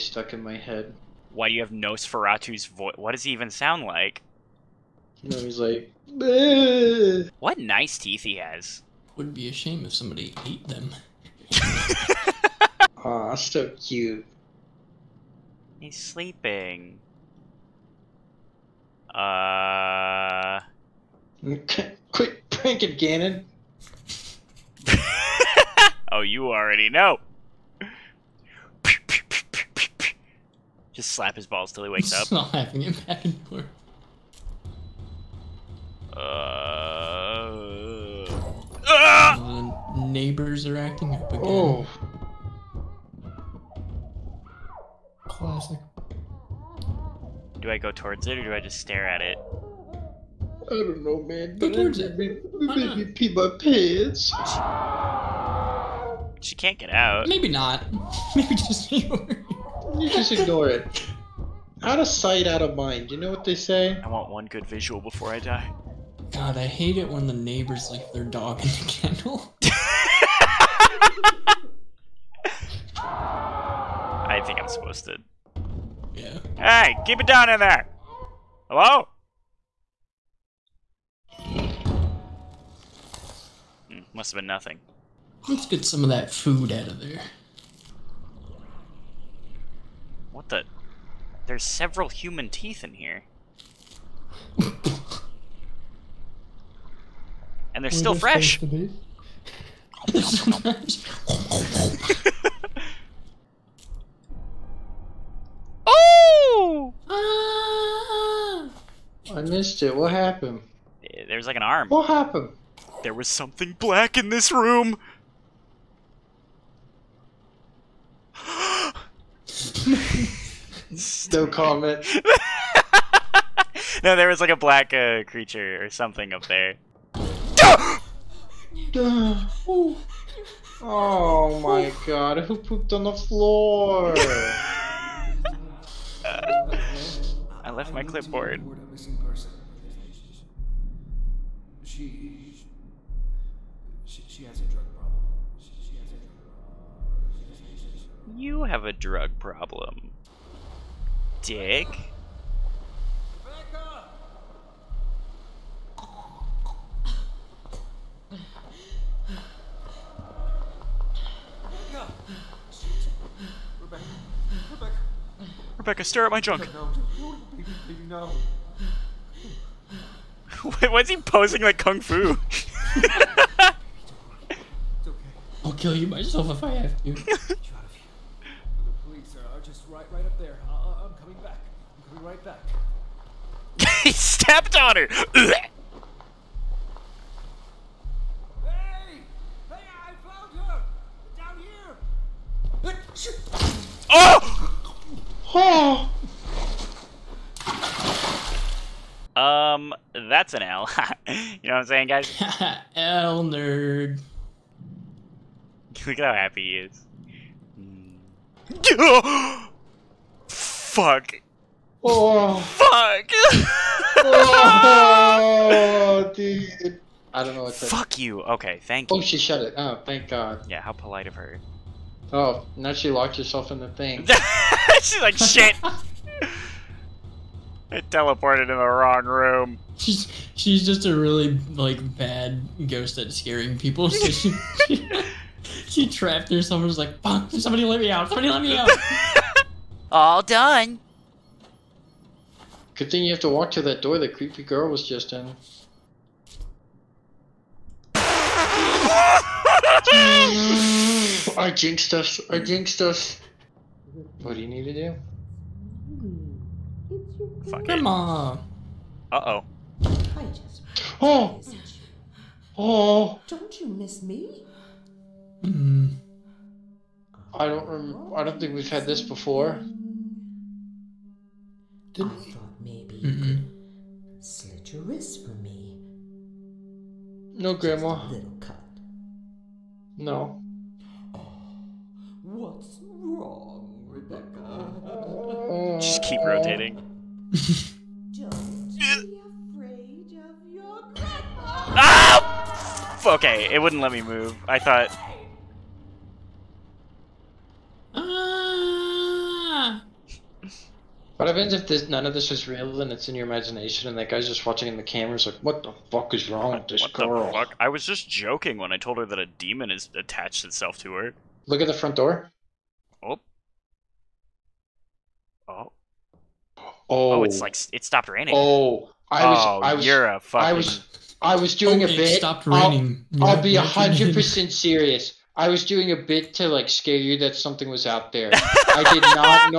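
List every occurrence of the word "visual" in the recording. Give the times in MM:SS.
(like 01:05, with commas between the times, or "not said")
01:04.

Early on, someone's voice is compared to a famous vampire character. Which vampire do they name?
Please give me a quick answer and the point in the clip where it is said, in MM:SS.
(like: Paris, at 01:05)
Nosferatu, at 00:01.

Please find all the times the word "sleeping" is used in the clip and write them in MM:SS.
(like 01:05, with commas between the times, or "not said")
00:15.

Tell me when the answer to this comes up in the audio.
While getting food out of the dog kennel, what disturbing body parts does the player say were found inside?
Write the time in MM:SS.
01:32.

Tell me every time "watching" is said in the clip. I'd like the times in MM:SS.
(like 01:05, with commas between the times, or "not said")
05:04.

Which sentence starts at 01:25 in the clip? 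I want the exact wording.
Let's get some of that food out of there.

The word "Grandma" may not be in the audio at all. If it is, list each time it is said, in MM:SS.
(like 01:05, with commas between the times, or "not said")
04:37.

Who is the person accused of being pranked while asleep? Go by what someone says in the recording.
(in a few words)
Gannon.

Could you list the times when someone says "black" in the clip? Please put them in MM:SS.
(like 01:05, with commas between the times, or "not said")
01:53, 02:04.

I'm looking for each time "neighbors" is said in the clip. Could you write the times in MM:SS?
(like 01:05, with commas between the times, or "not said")
00:40, 01:07.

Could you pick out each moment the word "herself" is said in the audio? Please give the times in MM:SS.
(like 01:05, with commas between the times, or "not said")
03:43, 03:56.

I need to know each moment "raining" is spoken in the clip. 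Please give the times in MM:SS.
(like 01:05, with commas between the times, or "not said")
05:18, 05:22.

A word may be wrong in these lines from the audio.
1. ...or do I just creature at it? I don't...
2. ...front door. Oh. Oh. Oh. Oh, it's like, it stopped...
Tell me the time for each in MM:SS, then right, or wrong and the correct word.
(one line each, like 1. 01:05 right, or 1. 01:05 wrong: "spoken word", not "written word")
1. 00:48 wrong: "stare", not "creature"
2. 05:11 right.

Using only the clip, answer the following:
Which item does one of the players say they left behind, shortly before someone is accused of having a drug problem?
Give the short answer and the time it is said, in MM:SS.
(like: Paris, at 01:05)
clipboard, at 02:18.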